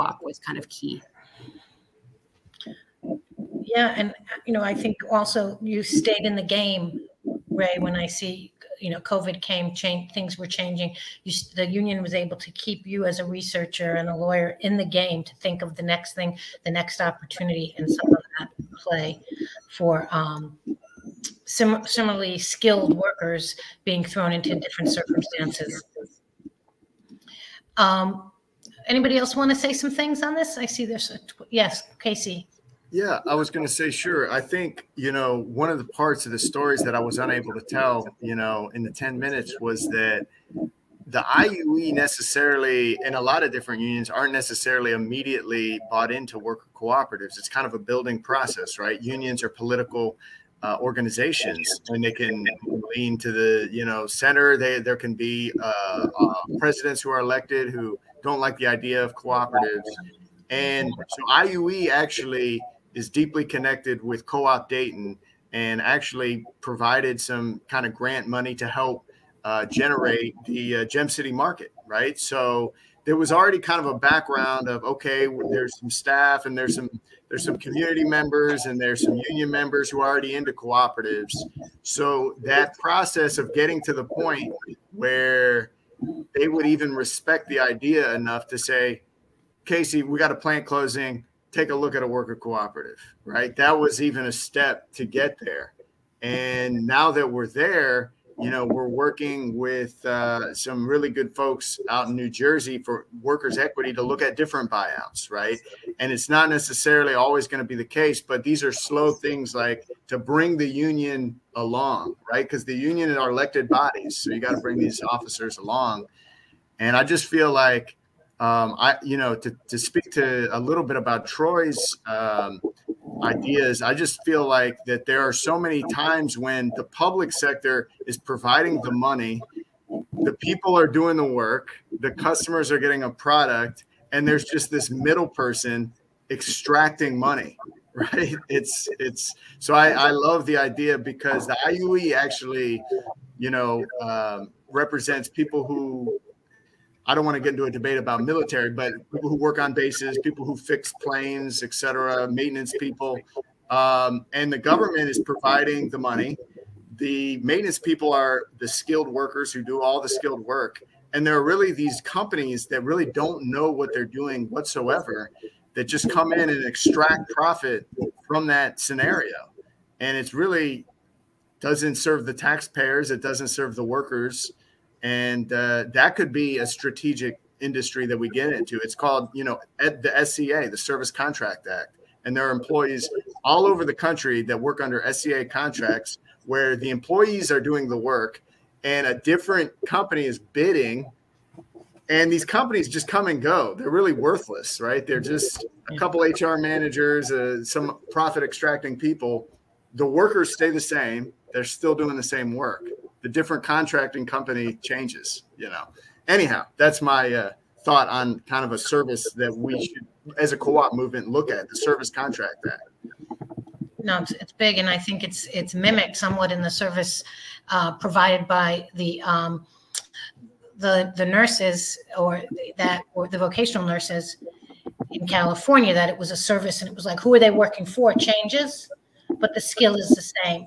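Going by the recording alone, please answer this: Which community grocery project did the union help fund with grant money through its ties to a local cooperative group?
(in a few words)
Gem City Market.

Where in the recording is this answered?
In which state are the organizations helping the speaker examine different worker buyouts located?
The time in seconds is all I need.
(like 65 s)
102 s.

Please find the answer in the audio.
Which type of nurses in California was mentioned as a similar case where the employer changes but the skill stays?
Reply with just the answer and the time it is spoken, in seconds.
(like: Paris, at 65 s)
vocational nurses, at 223 s.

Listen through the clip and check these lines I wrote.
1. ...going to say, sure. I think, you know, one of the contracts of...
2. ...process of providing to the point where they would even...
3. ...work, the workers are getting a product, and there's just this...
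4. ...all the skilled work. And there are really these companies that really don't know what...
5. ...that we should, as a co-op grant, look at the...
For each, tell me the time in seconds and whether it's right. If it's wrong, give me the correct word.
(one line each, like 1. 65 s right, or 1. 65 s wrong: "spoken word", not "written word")
1. 33 s wrong: "parts", not "contracts"
2. 82 s wrong: "getting", not "providing"
3. 131 s wrong: "customers", not "workers"
4. 159 s right
5. 209 s wrong: "movement", not "grant".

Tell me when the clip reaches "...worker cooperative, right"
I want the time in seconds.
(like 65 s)
92 s.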